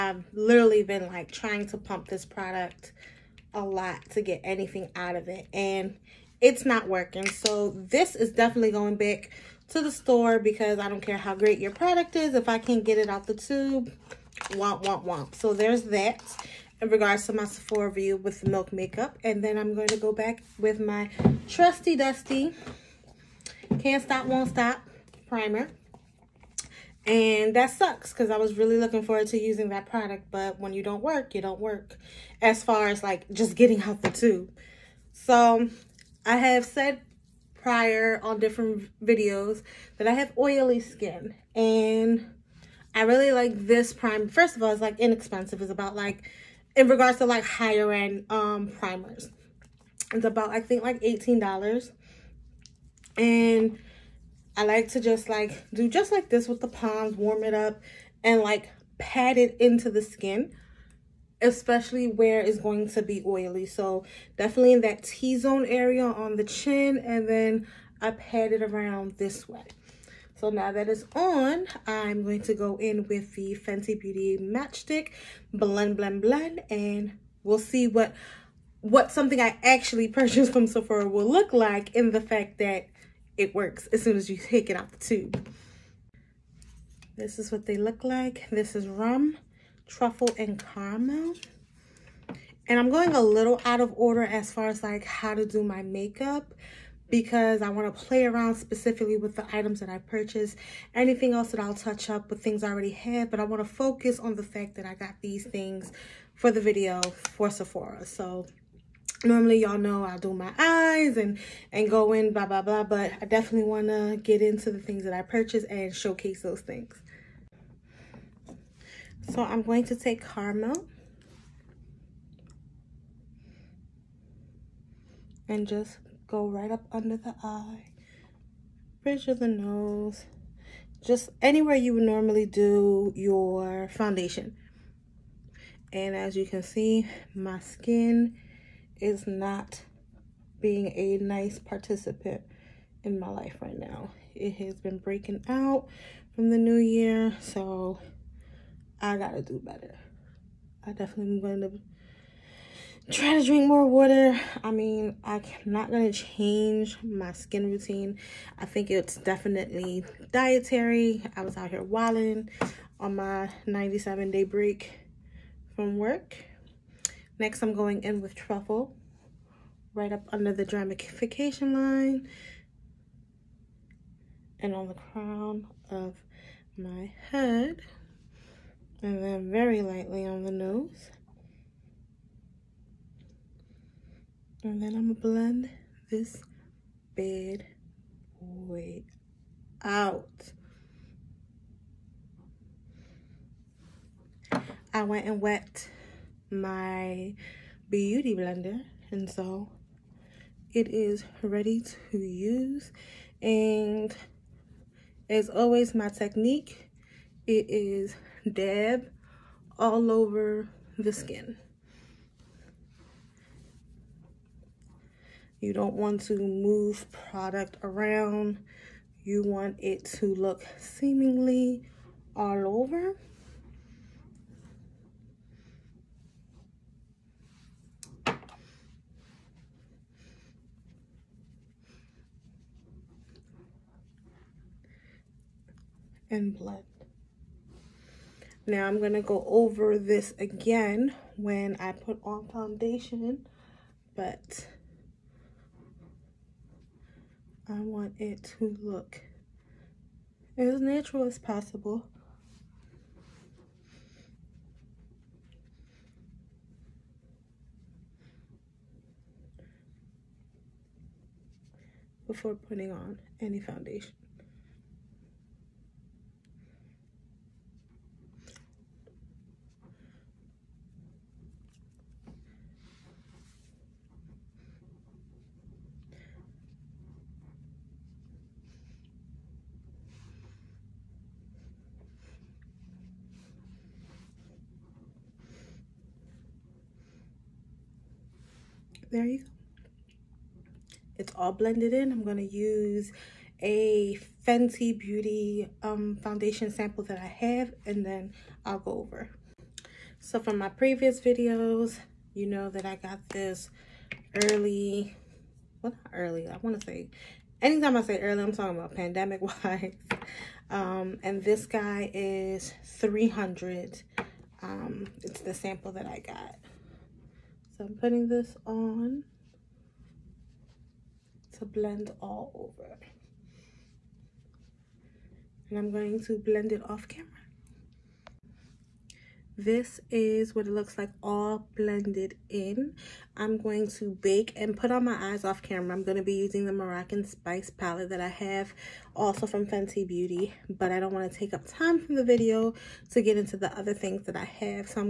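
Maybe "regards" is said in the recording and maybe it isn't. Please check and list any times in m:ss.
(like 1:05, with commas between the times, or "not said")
0:16, 0:46.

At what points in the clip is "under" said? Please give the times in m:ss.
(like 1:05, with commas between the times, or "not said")
2:06, 2:50.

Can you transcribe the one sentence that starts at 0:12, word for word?
If I can't get it out the tube, womp, womp, womp.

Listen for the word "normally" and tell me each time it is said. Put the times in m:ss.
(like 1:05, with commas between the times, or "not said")
1:49, 2:12.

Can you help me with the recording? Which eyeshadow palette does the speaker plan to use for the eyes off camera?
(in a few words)
Moroccan Spice.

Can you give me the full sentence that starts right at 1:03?
So definitely in that T-zone area on the chin and then I pat it around this way.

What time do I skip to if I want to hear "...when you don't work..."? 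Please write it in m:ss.
0:30.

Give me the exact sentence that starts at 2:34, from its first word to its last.
I mean, I'm not going to change my skin routine.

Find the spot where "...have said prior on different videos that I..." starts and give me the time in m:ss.
0:36.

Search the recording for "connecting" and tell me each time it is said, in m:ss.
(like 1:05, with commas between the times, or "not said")
not said.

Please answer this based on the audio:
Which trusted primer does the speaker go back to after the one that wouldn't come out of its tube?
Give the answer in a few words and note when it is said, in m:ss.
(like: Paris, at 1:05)
Can't Stop, Won't Stop, at 0:23.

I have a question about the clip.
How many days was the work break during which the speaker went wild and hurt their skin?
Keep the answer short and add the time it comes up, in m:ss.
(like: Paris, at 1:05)
97, at 2:43.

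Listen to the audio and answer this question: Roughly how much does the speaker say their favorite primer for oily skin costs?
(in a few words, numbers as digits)
$18.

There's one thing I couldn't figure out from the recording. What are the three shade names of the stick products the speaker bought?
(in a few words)
rum, truffle, and caramel.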